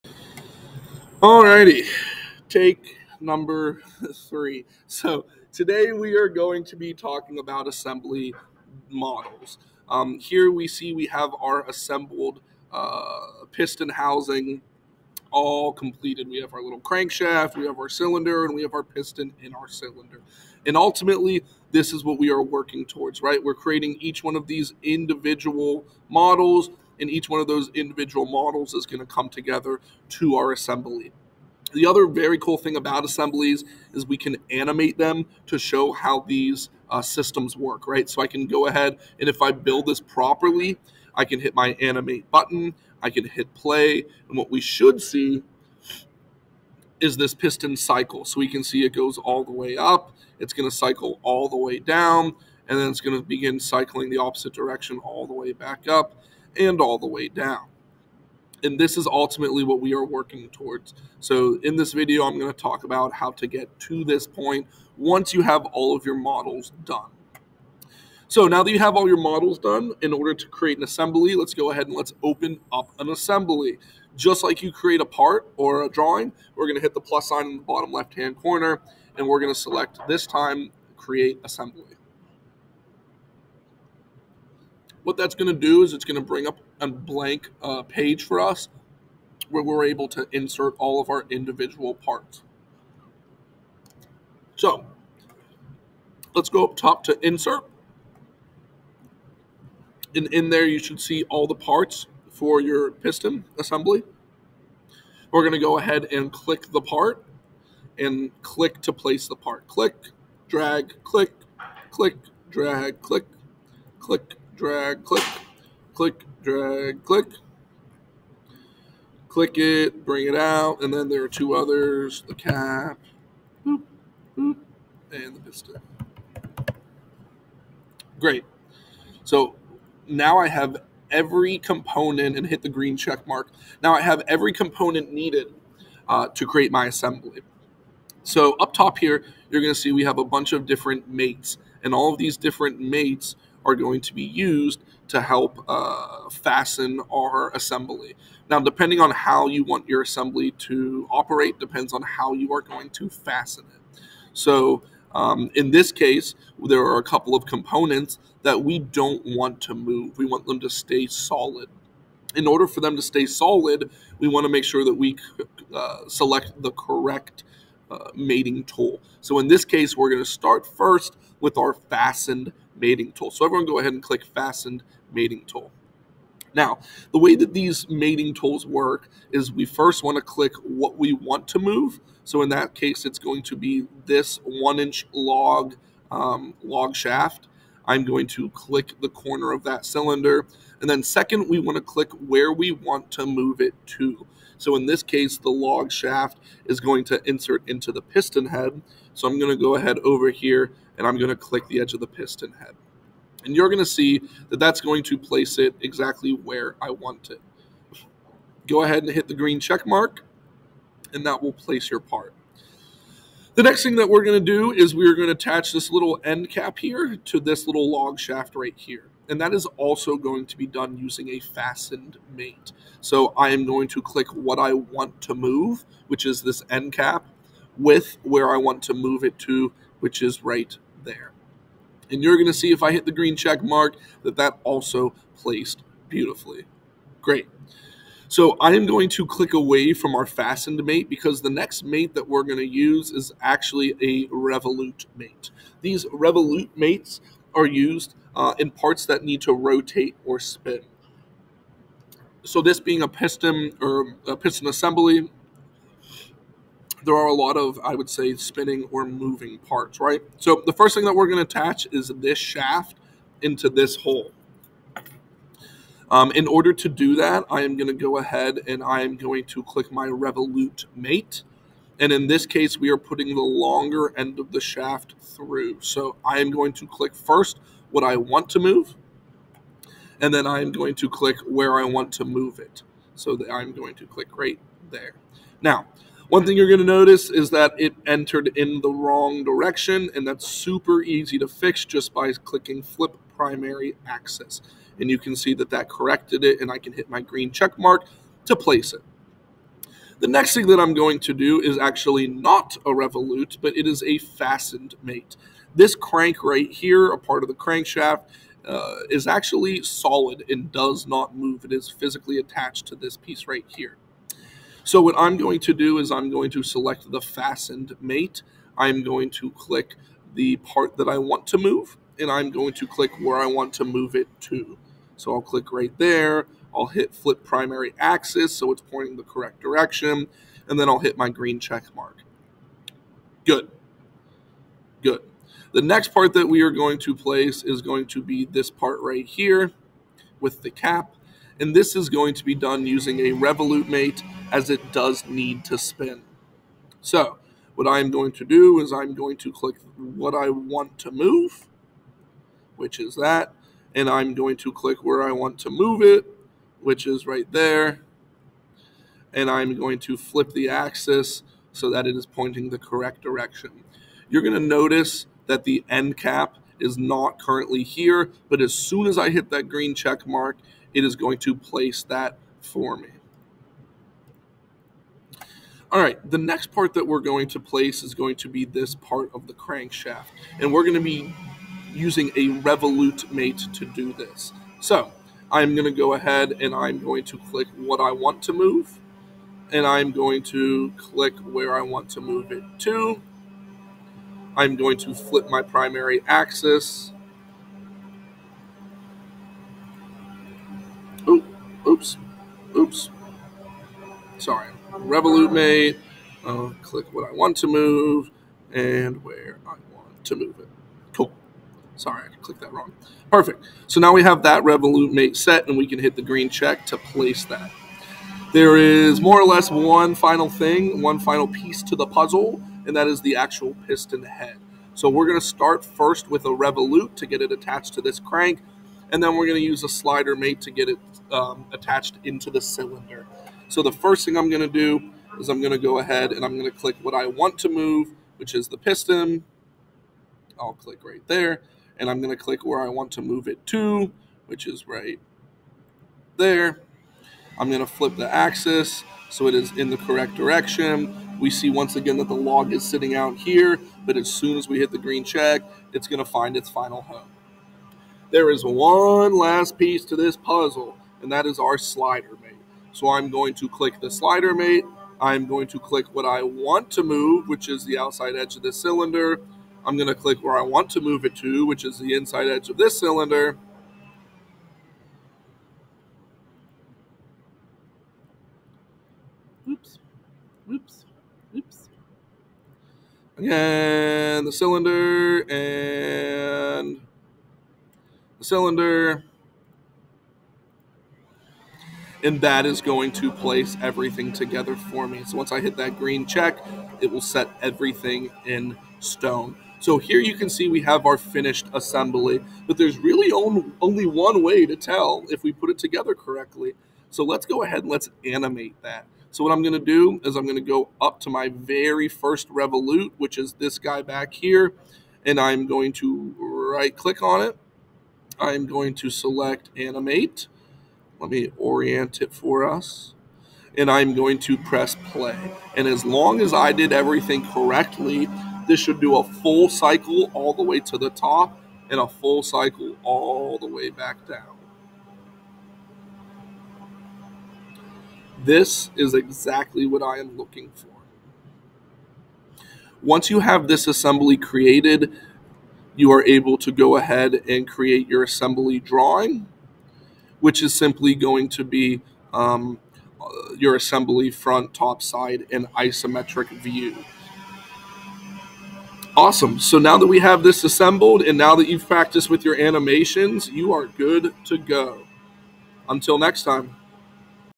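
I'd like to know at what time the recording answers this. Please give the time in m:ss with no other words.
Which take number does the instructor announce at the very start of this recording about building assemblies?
0:04.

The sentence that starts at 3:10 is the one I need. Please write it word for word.
And then second, we want to click where we want to move it to.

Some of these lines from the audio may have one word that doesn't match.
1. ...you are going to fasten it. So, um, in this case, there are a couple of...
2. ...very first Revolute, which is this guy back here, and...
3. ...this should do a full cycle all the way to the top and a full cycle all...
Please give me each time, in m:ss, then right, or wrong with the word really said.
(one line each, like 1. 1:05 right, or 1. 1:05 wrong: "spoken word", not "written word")
1. 2:32 right
2. 8:31 right
3. 8:48 right.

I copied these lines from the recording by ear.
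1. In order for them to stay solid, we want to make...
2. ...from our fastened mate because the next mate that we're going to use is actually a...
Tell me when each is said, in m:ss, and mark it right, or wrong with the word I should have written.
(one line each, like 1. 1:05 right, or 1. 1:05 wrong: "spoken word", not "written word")
1. 2:42 right
2. 3:59 right.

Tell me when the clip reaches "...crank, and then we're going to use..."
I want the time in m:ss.
7:08.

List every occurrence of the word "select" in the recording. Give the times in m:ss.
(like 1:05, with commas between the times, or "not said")
1:19, 2:46, 5:16, 8:39.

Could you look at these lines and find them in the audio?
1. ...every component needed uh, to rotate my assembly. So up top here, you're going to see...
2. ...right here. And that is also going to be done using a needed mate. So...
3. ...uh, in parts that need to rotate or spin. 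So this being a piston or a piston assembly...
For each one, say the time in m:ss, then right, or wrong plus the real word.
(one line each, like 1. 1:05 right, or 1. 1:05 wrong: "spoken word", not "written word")
1. 2:14 wrong: "create", not "rotate"
2. 3:38 wrong: "fastened", not "needed"
3. 4:08 right.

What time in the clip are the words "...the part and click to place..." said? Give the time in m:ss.
1:46.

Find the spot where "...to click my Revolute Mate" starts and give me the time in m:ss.
4:29.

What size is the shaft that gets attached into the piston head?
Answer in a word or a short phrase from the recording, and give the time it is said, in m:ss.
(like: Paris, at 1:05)
1 inch, at 3:04.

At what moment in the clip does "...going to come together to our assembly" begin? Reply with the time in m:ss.
0:28.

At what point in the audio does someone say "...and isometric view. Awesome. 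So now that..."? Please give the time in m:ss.
9:15.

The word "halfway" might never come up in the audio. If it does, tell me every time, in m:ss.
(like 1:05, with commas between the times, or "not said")
not said.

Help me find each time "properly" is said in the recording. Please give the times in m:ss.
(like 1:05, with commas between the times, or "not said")
0:40.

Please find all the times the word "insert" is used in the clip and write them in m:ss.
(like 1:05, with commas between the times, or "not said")
1:30, 1:37, 3:17.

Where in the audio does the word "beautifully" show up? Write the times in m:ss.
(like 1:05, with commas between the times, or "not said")
3:56.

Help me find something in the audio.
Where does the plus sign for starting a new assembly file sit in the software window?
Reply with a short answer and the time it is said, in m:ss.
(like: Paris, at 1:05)
bottom left-hand corner, at 1:17.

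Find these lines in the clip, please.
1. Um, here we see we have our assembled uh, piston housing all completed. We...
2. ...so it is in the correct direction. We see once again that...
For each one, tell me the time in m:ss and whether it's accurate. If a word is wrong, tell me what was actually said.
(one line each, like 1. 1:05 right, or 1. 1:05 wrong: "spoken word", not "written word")
1. 0:09 right
2. 7:29 right.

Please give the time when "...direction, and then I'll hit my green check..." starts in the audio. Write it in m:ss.
5:29.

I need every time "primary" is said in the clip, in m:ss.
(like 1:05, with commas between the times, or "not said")
4:53, 5:27, 6:35.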